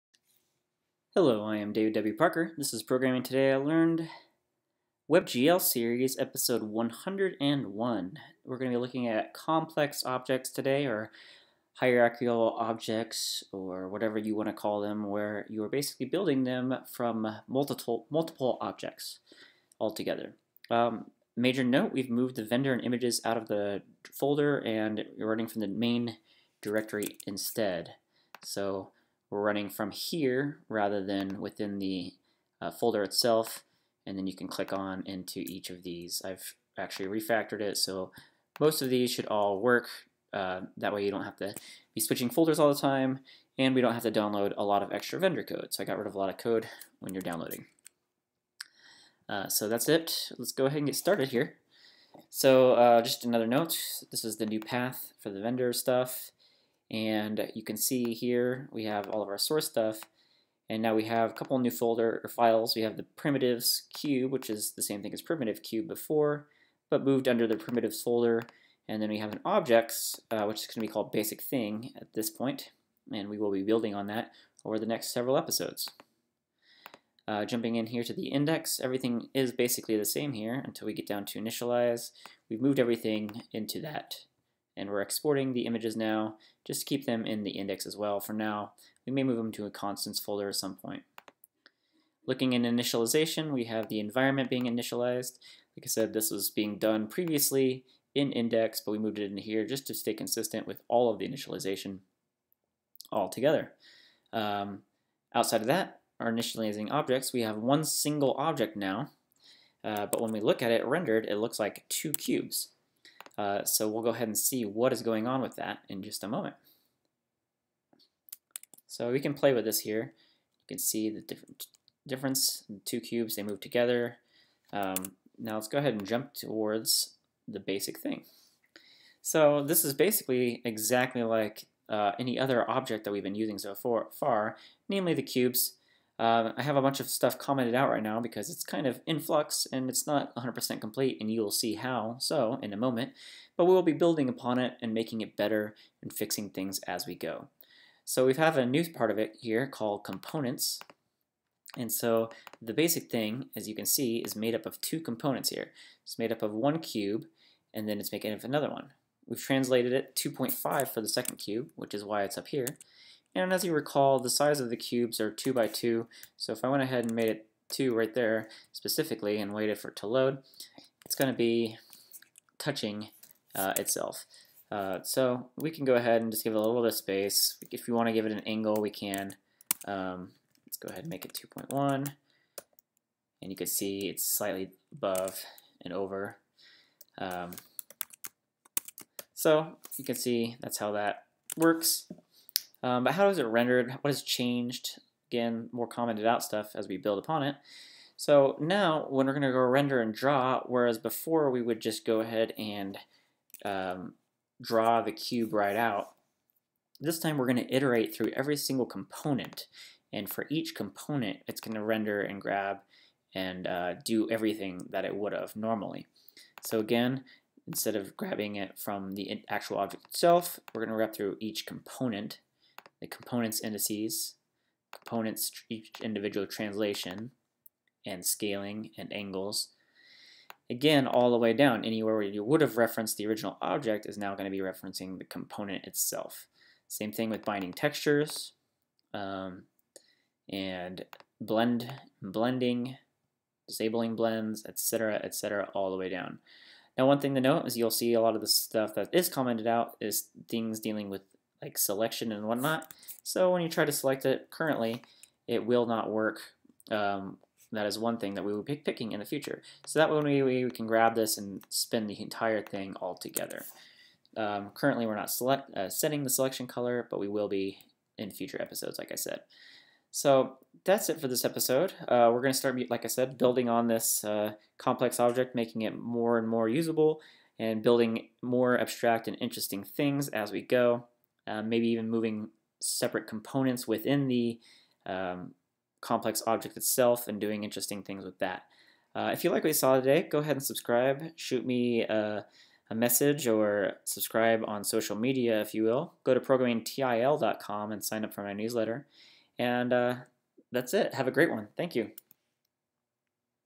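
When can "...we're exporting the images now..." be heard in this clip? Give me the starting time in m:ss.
1:24.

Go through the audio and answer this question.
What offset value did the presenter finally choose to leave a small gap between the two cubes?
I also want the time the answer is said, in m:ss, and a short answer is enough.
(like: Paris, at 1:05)
2.1, at 3:01.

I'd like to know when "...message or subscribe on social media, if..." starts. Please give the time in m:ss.
4:52.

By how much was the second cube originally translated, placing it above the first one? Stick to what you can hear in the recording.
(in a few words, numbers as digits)
2.5.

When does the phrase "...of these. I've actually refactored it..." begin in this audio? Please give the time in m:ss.
0:35.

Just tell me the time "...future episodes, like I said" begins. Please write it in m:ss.
4:28.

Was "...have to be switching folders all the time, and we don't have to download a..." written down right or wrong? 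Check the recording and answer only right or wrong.
right.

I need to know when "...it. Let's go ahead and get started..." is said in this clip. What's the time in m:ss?
0:49.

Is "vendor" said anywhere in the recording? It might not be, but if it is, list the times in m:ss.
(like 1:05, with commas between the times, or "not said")
0:22, 0:45, 0:55.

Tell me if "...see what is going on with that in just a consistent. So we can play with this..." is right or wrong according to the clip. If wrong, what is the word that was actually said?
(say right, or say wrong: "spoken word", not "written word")
wrong: "moment", not "consistent".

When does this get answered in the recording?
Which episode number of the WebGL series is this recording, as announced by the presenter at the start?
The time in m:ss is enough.
0:06.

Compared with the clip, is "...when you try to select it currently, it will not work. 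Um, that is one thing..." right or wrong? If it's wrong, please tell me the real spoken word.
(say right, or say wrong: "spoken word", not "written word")
right.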